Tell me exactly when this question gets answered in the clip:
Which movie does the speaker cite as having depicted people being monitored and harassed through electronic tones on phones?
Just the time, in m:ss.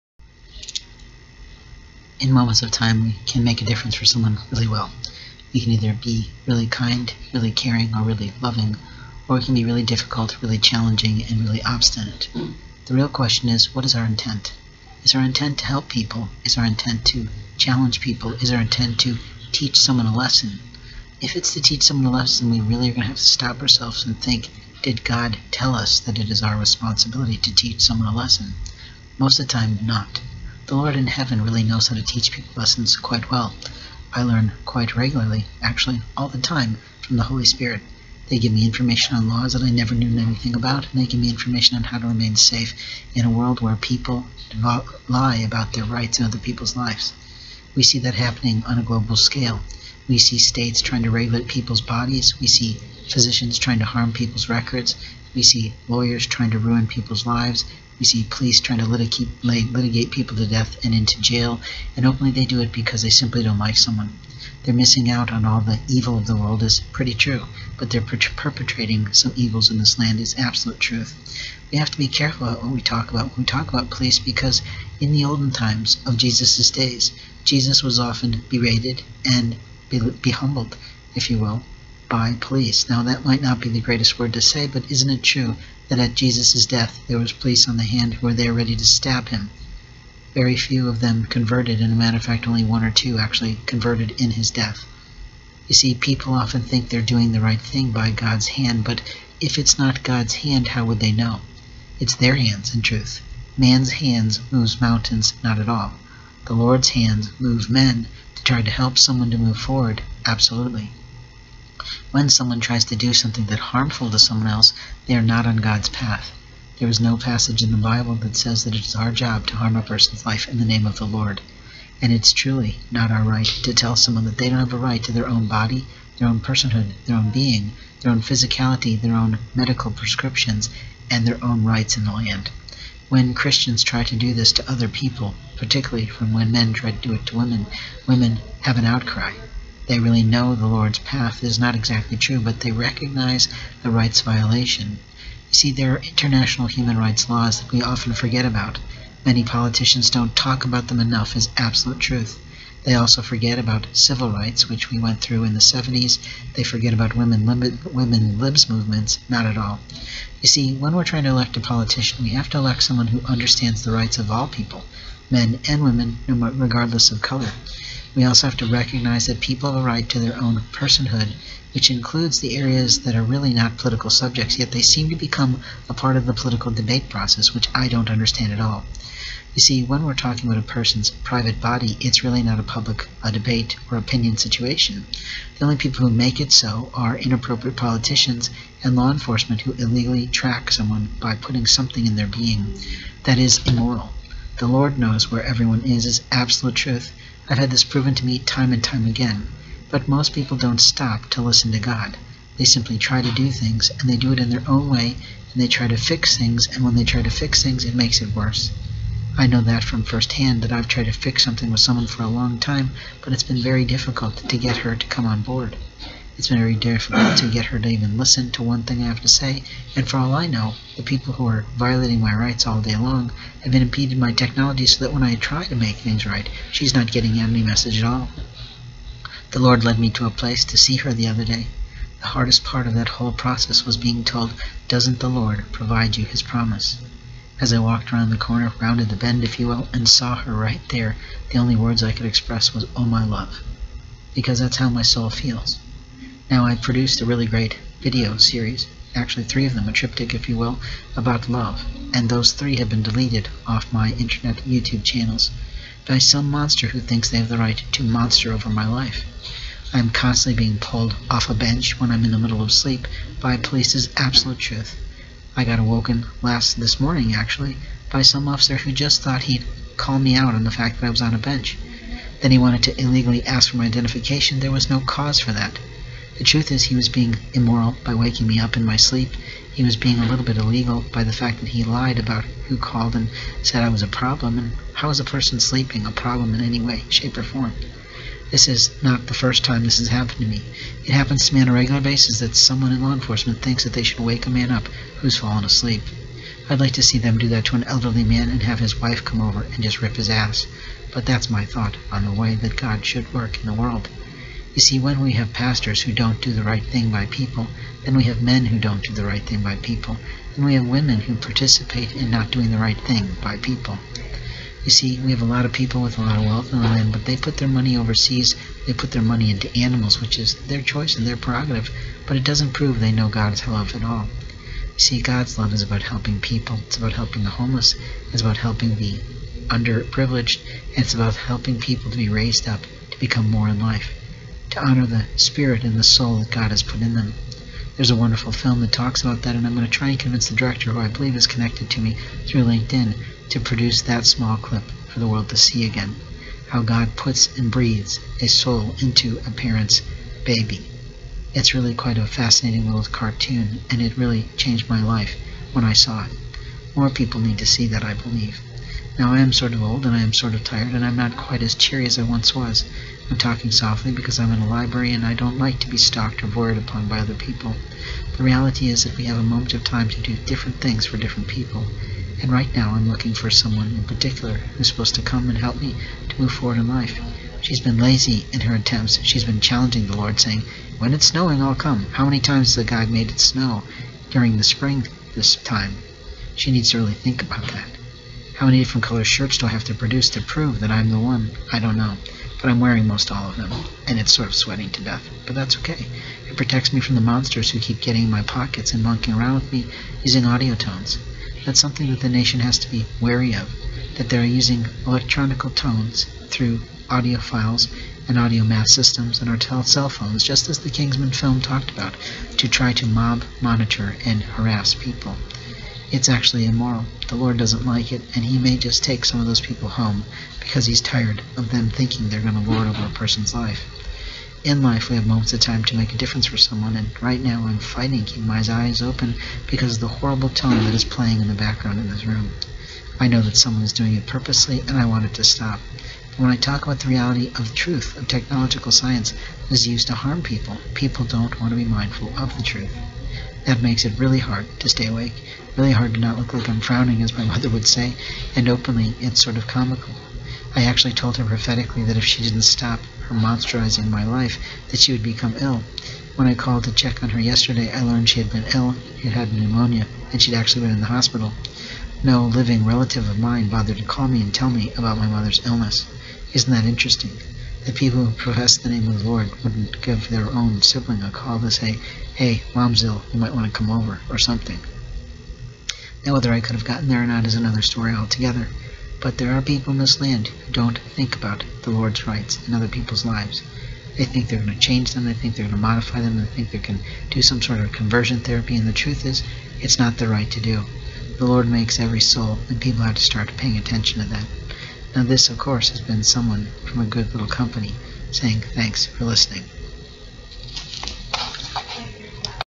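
6:50.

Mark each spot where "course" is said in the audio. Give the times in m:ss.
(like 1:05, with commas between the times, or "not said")
8:15.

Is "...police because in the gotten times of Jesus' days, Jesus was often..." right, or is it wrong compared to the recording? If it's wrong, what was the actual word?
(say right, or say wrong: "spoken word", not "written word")
wrong: "olden", not "gotten".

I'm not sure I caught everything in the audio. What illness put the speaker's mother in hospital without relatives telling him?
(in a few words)
pneumonia.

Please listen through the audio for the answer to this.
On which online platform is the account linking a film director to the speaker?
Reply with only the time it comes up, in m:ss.
5:42.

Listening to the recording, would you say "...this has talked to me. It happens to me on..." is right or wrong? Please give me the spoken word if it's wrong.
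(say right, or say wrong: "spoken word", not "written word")
wrong: "happened", not "talked".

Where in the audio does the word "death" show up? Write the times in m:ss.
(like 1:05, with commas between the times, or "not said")
1:00, 1:26, 1:34, 6:35.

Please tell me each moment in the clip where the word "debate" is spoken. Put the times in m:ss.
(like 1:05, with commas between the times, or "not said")
2:56, 3:03.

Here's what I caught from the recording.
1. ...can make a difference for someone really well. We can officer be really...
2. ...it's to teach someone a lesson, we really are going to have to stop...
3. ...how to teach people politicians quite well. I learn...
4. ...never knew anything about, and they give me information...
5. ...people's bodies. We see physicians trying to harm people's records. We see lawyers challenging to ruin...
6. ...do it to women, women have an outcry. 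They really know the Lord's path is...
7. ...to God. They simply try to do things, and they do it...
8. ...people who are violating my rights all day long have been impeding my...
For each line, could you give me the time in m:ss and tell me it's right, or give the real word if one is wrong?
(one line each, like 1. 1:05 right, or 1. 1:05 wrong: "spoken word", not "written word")
1. 0:03 wrong: "either", not "officer"
2. 0:21 right
3. 0:31 wrong: "lessons", not "politicians"
4. 0:39 right
5. 0:51 wrong: "trying", not "challenging"
6. 2:17 right
7. 3:21 right
8. 3:41 right.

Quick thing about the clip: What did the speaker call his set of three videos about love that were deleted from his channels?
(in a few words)
a triptych.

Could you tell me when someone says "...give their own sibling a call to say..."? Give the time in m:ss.
7:50.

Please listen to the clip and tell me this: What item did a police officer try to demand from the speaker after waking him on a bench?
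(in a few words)
identification.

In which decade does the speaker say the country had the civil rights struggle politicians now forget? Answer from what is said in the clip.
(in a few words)
the 70s.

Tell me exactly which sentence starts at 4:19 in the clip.
I'm constantly being pulled off a bench when I'm in the middle of sleep by police's absolute truth.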